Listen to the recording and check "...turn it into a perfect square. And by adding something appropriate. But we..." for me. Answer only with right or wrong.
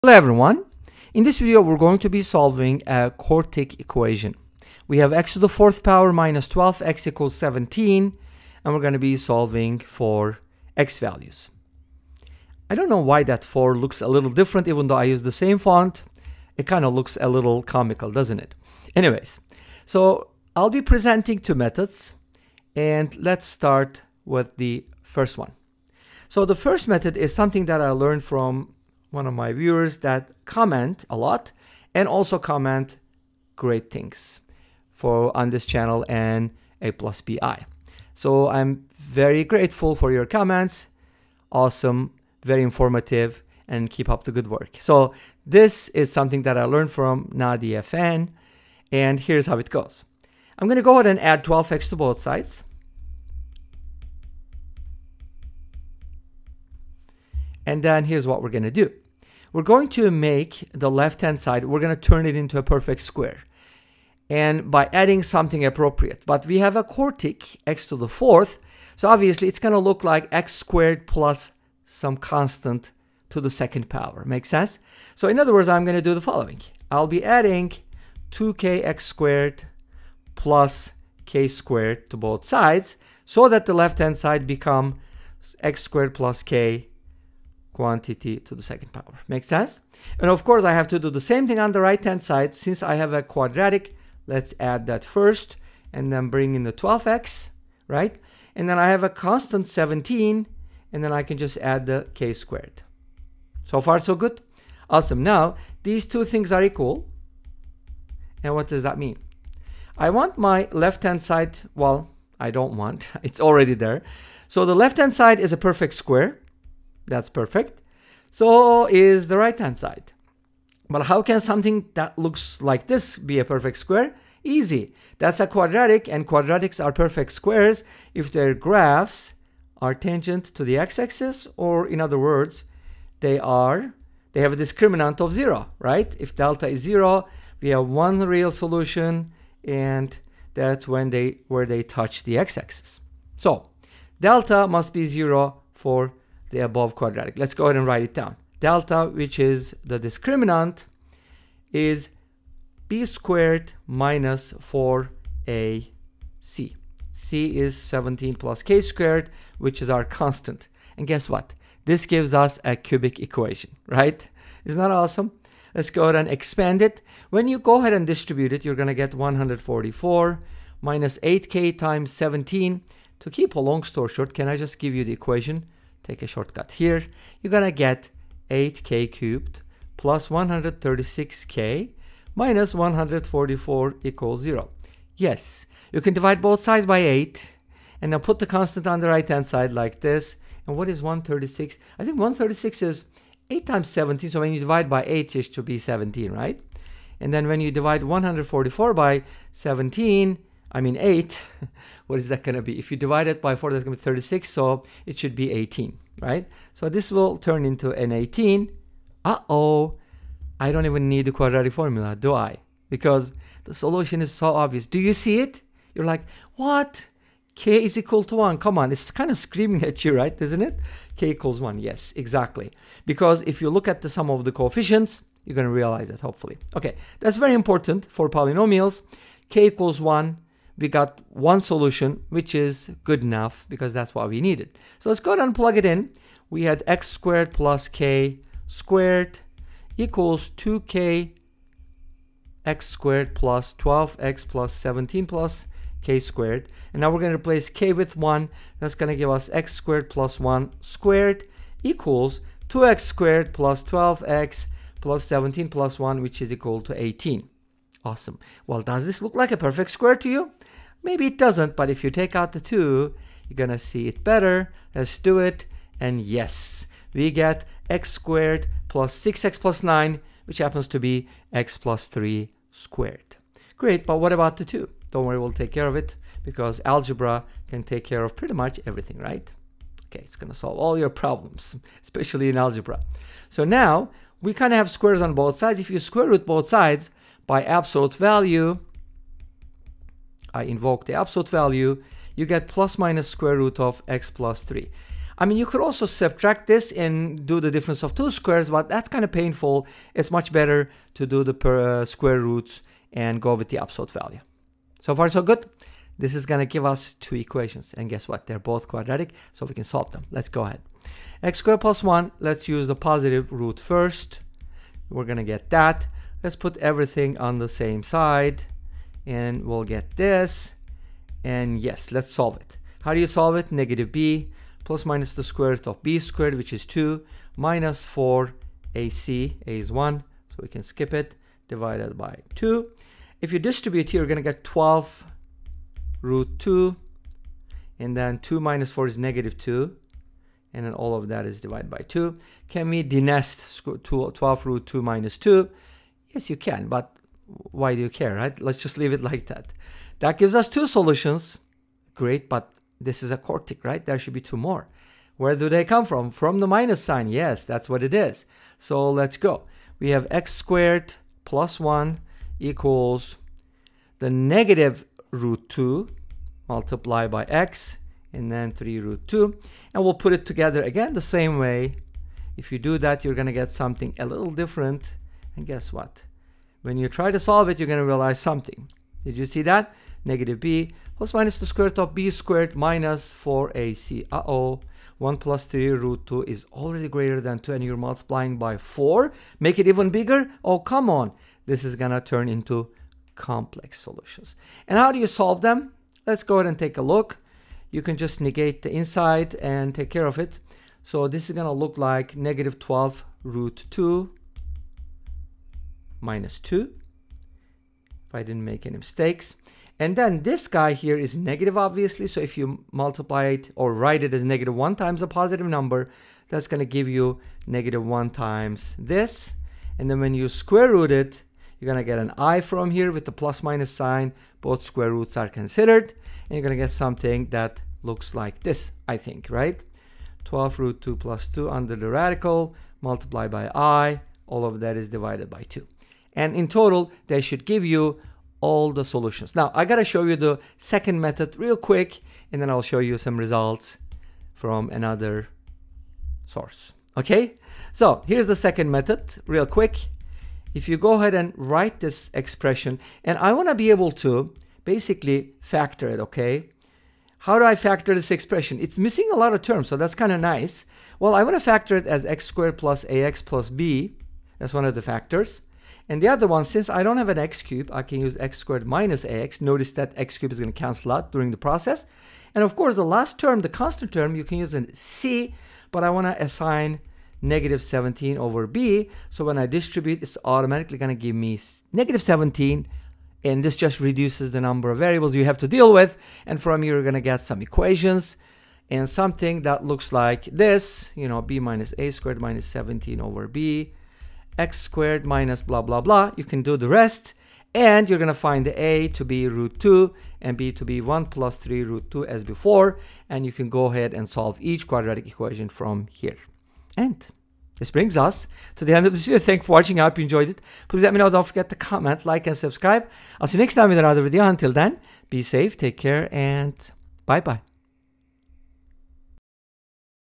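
right.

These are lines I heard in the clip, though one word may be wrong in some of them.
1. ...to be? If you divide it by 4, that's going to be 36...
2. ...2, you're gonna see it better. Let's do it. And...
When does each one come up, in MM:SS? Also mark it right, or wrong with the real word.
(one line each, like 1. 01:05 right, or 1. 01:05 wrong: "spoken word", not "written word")
1. 03:22 right
2. 04:22 right.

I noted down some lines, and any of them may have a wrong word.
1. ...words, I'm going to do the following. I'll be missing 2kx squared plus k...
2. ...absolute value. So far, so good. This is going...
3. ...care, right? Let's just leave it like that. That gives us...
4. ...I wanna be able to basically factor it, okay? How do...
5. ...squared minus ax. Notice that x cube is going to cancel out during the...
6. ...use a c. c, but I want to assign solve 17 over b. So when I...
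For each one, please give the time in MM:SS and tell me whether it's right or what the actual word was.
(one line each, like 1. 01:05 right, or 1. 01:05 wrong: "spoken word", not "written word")
1. 01:15 wrong: "adding", not "missing"
2. 05:03 right
3. 05:48 right
4. 07:33 right
5. 07:48 right
6. 07:54 wrong: "negative", not "solve".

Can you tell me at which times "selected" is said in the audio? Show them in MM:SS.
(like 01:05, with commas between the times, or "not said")
not said.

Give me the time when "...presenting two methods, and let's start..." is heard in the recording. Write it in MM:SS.
00:20.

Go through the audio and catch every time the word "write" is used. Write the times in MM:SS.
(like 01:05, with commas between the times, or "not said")
02:27, 06:53, 07:31.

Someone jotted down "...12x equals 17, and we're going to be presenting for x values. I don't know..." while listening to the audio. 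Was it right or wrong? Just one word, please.
wrong.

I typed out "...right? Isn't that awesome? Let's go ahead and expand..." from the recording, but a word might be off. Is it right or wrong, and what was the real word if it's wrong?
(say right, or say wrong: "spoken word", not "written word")
right.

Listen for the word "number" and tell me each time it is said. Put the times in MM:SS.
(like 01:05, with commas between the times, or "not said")
06:55, 08:04.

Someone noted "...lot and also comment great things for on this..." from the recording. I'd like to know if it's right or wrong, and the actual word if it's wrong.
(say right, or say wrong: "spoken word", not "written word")
right.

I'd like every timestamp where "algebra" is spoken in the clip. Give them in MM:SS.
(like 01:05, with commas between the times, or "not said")
04:36, 04:42.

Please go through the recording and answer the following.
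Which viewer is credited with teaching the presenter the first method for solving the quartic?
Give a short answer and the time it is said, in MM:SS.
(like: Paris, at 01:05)
NadiehFan, at 00:47.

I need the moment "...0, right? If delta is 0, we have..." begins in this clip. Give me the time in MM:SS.
02:15.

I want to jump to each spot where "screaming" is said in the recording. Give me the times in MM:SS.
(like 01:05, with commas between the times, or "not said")
03:39.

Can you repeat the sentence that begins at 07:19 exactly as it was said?
Now I gotta show you the second method real quick and then I'll show you some results from another source.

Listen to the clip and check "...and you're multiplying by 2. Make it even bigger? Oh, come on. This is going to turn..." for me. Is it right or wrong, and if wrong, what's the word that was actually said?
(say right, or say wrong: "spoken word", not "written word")
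wrong: "4", not "2".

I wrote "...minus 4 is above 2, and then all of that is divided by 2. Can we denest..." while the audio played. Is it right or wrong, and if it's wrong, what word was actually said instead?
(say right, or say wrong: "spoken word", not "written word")
wrong: "negative", not "above".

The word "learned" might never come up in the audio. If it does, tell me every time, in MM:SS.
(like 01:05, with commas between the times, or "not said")
00:27, 00:46.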